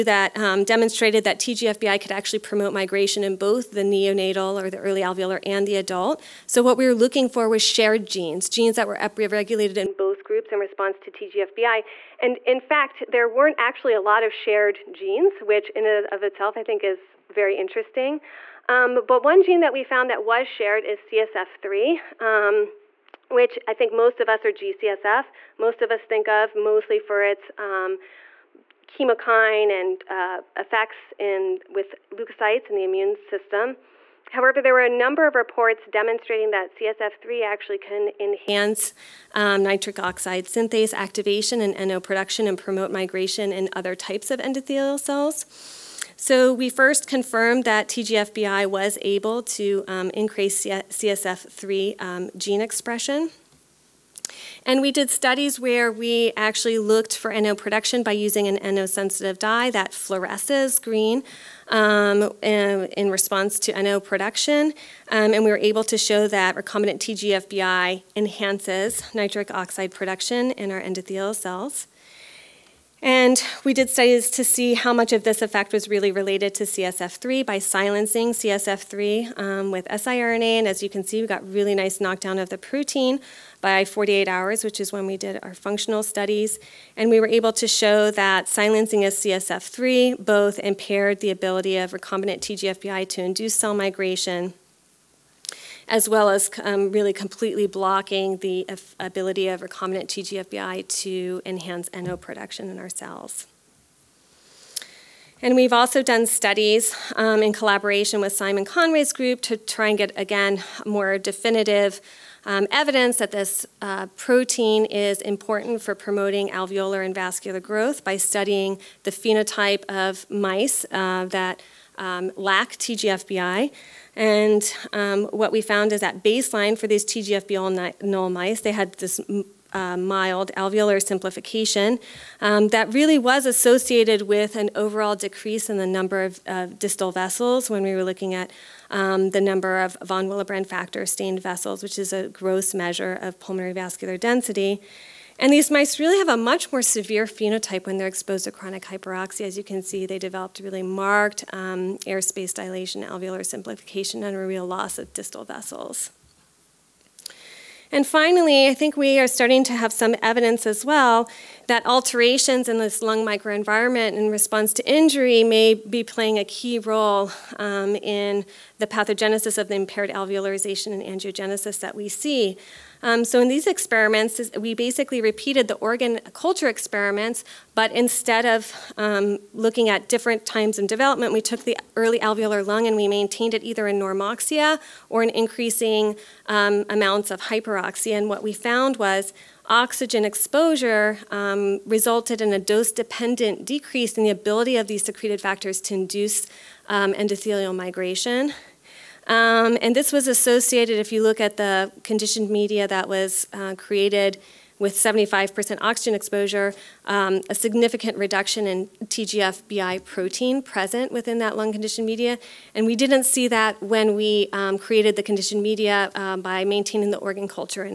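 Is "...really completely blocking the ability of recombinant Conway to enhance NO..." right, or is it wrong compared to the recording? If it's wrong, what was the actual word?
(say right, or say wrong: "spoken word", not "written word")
wrong: "TGFBI", not "Conway".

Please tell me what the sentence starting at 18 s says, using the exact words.
Um, but one gene that we found that was shared is CSF3 which I think most of us are GCSF.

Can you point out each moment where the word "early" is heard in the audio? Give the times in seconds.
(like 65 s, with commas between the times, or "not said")
4 s, 181 s.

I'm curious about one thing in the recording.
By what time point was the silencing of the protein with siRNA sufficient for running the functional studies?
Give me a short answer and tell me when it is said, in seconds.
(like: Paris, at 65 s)
48 hours, at 83 s.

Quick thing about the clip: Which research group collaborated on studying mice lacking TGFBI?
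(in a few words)
Simon Conway's group.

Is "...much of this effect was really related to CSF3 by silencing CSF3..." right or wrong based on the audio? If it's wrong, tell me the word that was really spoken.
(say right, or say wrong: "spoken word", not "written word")
right.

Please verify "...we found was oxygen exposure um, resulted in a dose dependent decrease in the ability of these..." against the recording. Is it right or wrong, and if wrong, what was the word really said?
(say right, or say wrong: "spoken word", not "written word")
right.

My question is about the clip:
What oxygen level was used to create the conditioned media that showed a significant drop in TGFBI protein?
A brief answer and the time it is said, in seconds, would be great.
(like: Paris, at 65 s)
75%, at 204 s.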